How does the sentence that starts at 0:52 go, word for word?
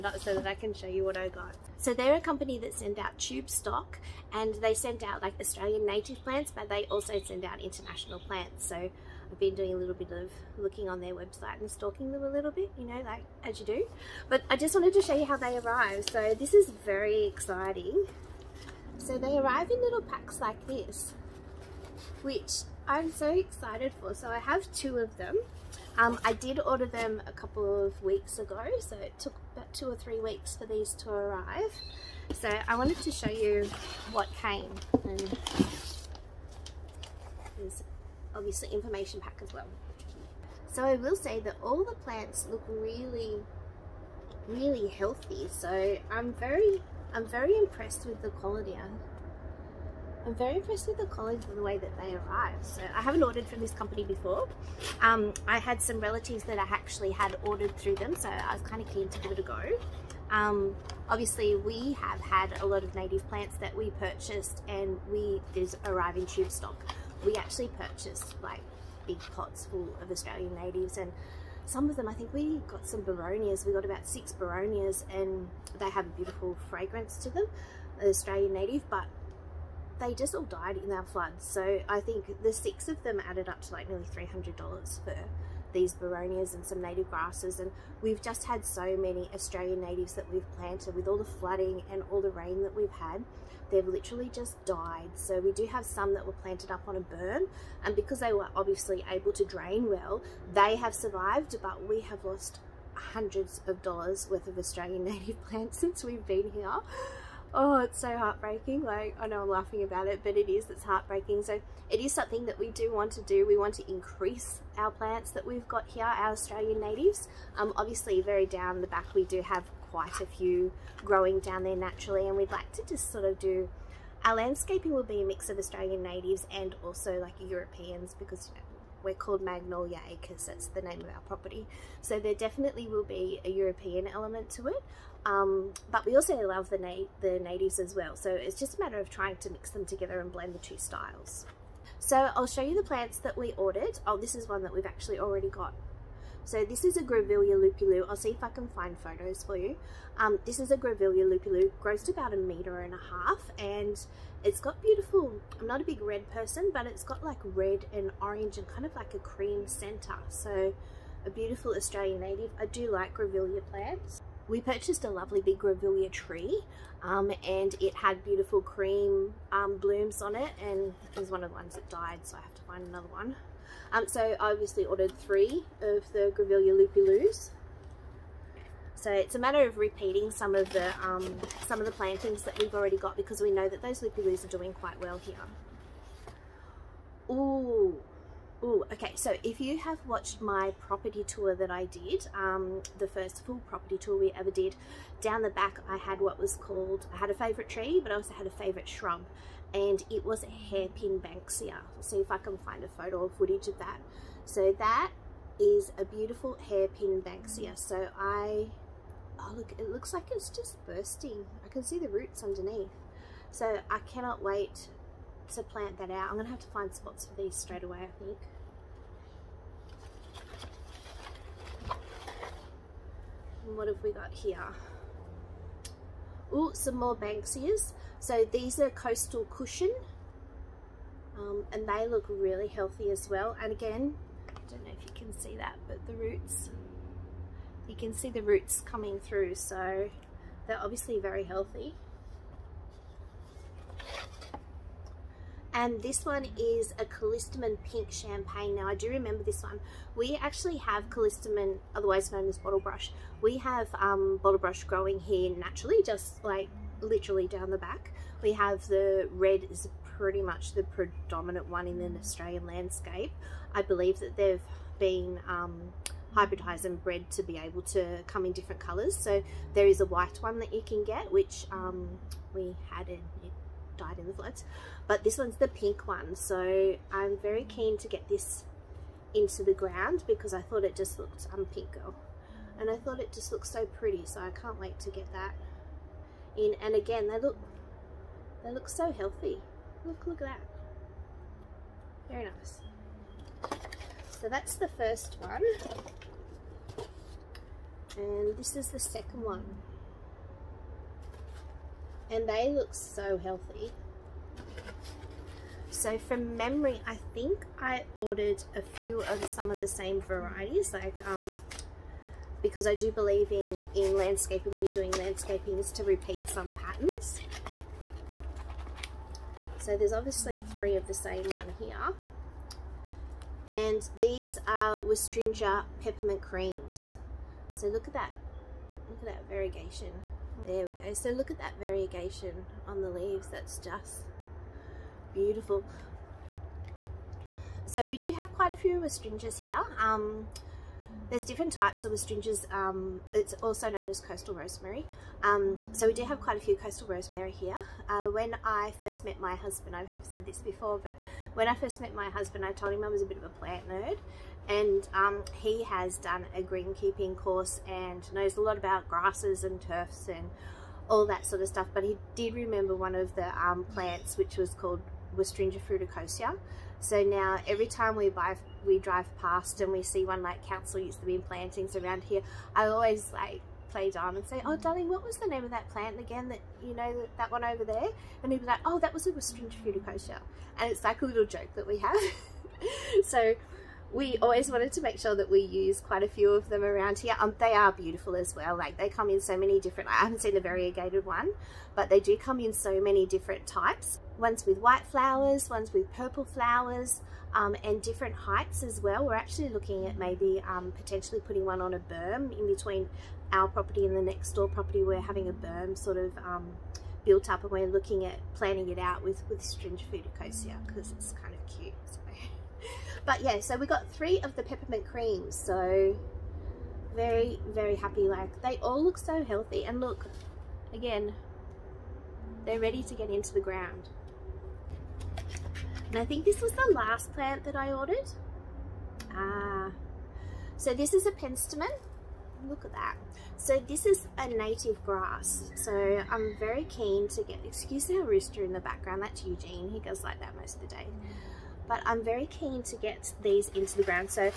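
So I haven't ordered from this company before.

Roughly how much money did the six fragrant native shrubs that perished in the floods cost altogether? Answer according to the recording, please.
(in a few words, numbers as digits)
nearly $300.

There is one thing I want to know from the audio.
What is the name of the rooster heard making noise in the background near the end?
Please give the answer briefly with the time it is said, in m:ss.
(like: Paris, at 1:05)
Eugene, at 7:19.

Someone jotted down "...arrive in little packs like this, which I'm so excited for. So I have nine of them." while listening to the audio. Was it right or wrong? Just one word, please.
wrong.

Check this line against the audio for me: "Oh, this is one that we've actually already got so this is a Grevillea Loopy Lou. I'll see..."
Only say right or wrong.
right.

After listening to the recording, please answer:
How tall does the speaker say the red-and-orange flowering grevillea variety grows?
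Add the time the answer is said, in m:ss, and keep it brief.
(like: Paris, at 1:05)
a meter and a half, at 2:32.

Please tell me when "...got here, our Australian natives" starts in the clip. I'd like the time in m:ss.
1:55.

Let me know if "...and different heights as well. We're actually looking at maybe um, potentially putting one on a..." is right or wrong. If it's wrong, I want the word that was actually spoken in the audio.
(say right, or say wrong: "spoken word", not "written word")
right.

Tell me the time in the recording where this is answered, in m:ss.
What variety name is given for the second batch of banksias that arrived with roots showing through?
3:48.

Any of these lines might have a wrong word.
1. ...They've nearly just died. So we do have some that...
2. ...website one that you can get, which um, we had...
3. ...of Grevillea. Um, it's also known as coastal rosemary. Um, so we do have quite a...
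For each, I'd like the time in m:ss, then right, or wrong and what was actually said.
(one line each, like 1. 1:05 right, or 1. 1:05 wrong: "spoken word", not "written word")
1. 1:33 wrong: "literally", not "nearly"
2. 4:30 wrong: "white", not "website"
3. 5:42 wrong: "Westringias", not "Grevillea".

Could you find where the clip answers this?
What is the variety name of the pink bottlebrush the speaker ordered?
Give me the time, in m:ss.
4:07.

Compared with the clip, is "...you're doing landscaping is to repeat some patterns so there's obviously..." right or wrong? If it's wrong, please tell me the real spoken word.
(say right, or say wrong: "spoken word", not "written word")
right.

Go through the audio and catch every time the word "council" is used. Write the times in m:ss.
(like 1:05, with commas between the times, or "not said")
6:10.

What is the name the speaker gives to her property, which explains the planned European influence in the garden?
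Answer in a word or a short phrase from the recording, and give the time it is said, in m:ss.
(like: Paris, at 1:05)
Magnolia Acres, at 2:09.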